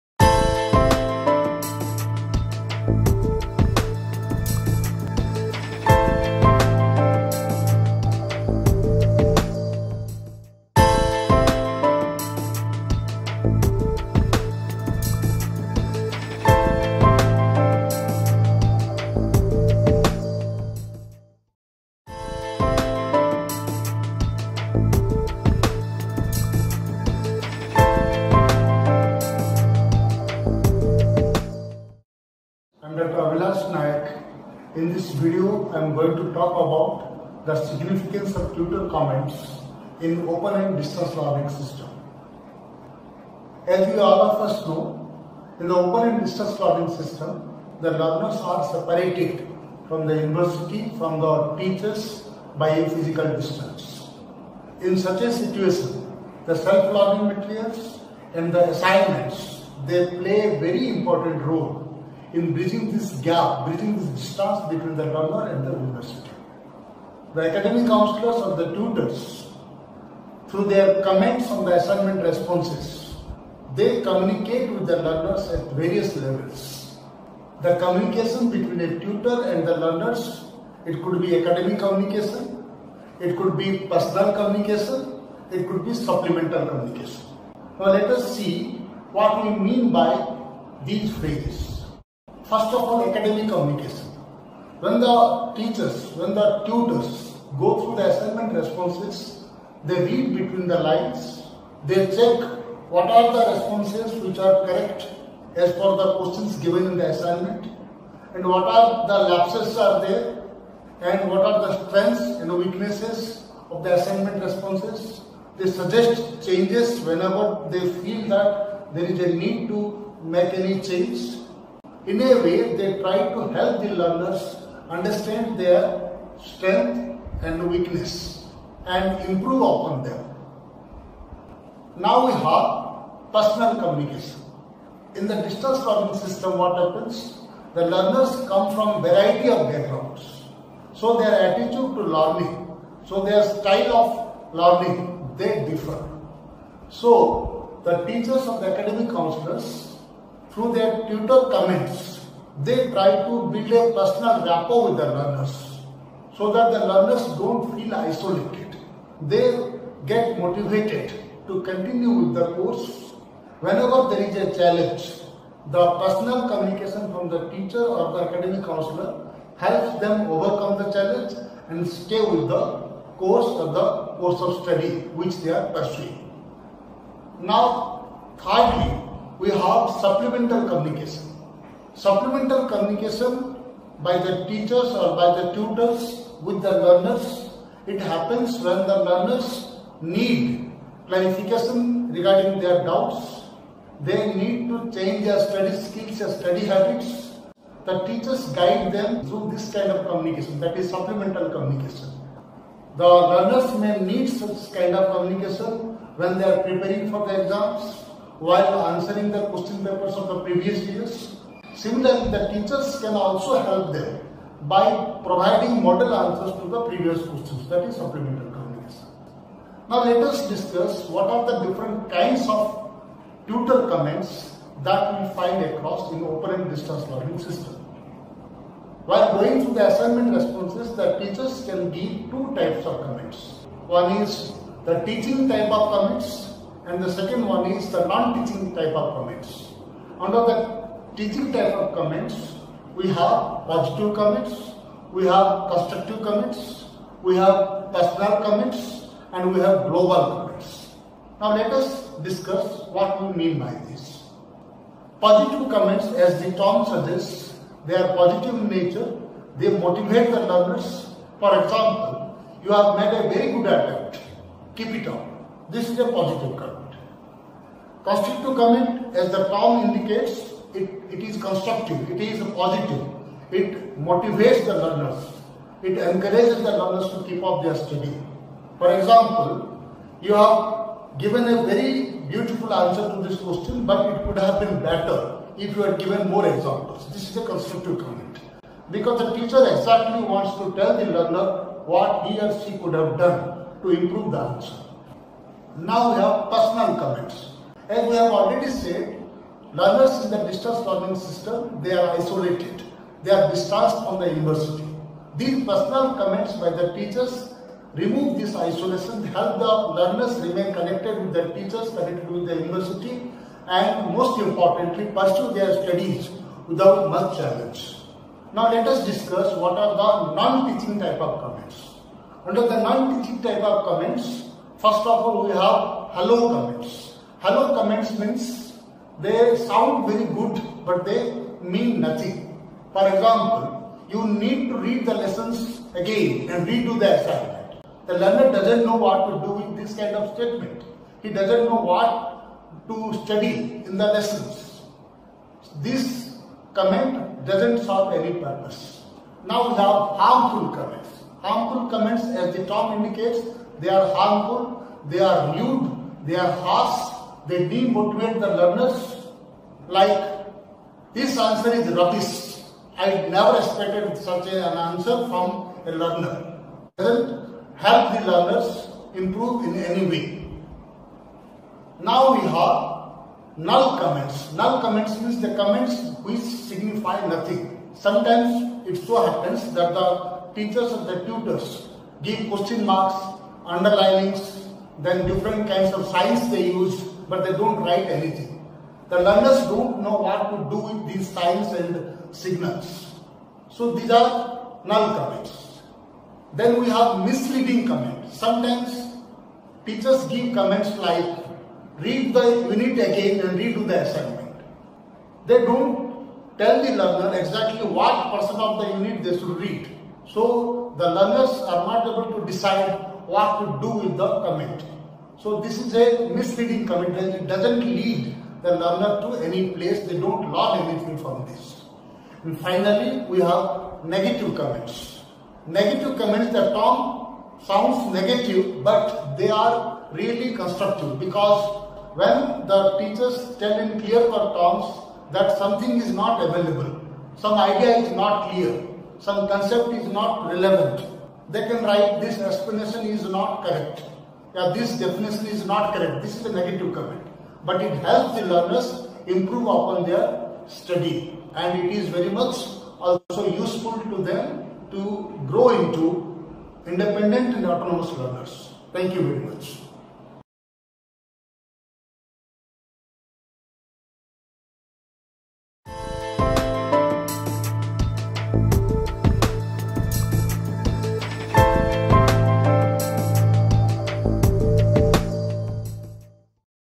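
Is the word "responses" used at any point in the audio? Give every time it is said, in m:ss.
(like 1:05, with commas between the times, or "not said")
1:12, 1:38, 1:43, 1:54, 3:50.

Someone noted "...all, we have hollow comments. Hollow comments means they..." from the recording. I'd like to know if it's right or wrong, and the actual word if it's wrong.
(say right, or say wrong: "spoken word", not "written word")
right.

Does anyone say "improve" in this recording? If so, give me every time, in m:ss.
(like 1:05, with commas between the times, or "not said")
2:09, 4:53, 6:09, 7:29.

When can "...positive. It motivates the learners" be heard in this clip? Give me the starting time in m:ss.
4:32.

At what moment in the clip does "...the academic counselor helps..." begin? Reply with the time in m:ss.
2:48.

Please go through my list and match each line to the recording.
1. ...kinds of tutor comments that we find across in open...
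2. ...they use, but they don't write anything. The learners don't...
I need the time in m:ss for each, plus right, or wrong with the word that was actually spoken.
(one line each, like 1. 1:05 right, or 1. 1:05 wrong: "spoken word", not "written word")
1. 3:42 right
2. 6:26 right.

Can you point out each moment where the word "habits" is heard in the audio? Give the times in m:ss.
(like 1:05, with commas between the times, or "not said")
3:16.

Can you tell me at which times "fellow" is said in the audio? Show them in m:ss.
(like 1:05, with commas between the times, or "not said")
not said.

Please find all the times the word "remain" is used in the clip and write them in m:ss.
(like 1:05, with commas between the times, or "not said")
5:10.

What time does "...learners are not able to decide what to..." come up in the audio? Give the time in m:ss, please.
6:51.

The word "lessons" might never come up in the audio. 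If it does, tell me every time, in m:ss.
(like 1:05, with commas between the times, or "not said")
5:35, 5:44.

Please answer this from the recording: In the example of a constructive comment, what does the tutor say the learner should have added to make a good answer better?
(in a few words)
More examples.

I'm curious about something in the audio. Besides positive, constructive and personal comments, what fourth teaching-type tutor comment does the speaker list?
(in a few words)
Global comments.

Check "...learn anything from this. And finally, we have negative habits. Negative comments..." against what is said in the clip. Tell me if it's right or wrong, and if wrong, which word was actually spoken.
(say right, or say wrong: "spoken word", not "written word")
wrong: "comments", not "habits".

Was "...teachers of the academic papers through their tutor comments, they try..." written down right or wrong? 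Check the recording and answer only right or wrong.
wrong.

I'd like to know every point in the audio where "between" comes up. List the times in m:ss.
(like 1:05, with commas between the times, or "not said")
1:04, 1:18, 1:40.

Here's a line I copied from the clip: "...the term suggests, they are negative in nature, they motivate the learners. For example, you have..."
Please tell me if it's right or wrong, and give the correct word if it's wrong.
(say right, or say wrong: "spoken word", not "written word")
wrong: "positive", not "negative".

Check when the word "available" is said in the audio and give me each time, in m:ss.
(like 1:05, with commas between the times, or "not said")
7:16.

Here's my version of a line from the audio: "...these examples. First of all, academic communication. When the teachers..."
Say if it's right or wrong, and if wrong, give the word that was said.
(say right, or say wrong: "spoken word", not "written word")
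wrong: "phrases", not "examples".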